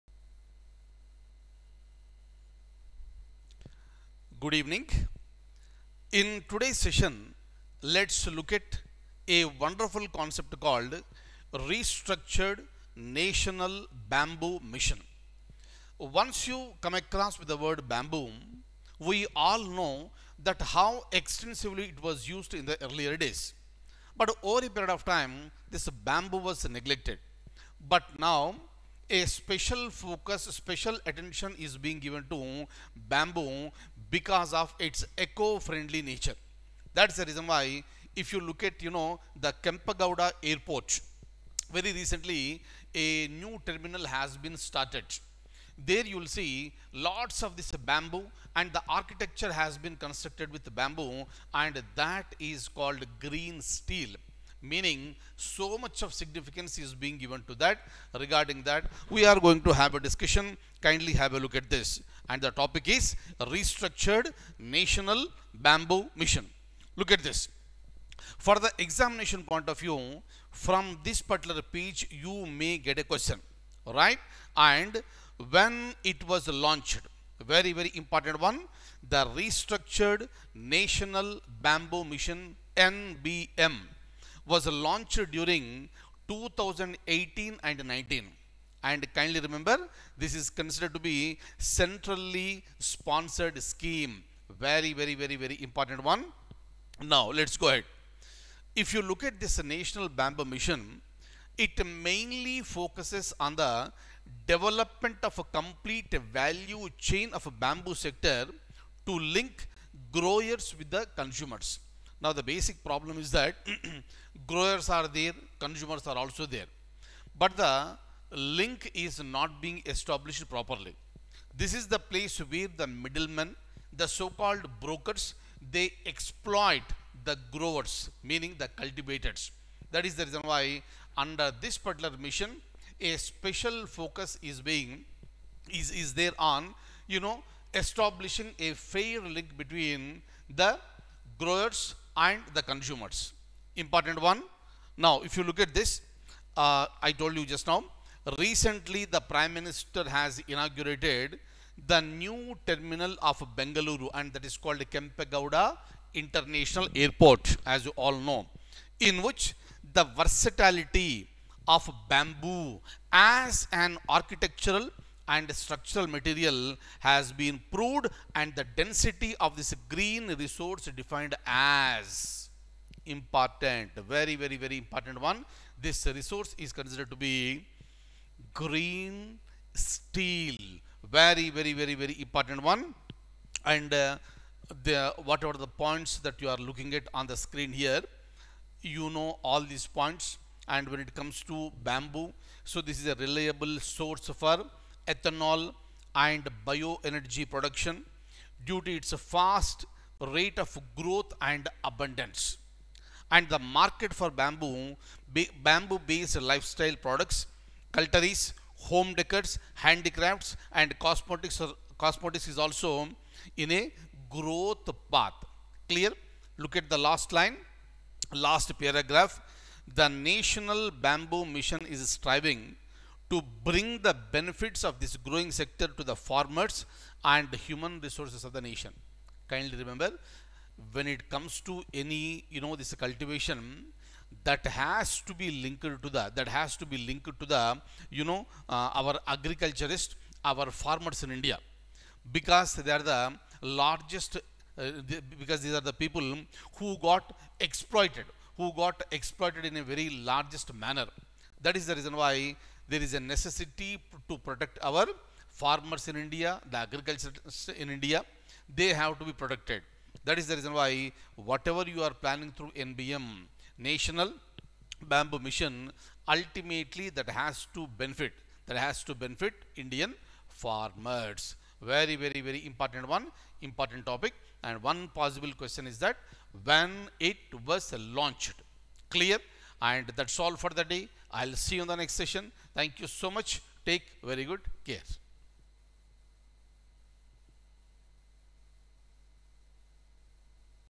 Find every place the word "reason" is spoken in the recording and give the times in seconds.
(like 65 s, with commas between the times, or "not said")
37 s, 130 s, 251 s, 260 s.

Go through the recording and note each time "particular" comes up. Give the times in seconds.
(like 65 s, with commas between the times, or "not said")
71 s, 131 s.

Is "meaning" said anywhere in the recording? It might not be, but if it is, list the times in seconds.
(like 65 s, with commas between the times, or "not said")
54 s, 128 s.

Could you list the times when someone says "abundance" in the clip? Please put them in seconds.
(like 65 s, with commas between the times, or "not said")
201 s.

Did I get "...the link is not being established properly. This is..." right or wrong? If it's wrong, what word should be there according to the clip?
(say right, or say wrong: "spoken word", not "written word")
right.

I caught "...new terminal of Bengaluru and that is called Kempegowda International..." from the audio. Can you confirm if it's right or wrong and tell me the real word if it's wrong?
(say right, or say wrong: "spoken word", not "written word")
right.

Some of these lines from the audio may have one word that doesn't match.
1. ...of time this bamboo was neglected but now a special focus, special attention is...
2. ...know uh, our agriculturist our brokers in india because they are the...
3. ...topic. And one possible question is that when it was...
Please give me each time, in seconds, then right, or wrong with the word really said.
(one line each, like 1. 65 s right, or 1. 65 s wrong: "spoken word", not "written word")
1. 24 s right
2. 238 s wrong: "farmers", not "brokers"
3. 274 s right.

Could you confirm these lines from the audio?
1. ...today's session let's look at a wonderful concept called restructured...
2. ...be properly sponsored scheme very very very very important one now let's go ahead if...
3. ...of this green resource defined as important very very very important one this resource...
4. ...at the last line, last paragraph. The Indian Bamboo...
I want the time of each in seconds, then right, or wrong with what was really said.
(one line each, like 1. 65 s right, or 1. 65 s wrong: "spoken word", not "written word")
1. 6 s right
2. 91 s wrong: "centrally", not "properly"
3. 169 s right
4. 216 s wrong: "National", not "Indian".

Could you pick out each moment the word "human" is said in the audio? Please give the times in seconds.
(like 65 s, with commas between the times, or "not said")
227 s.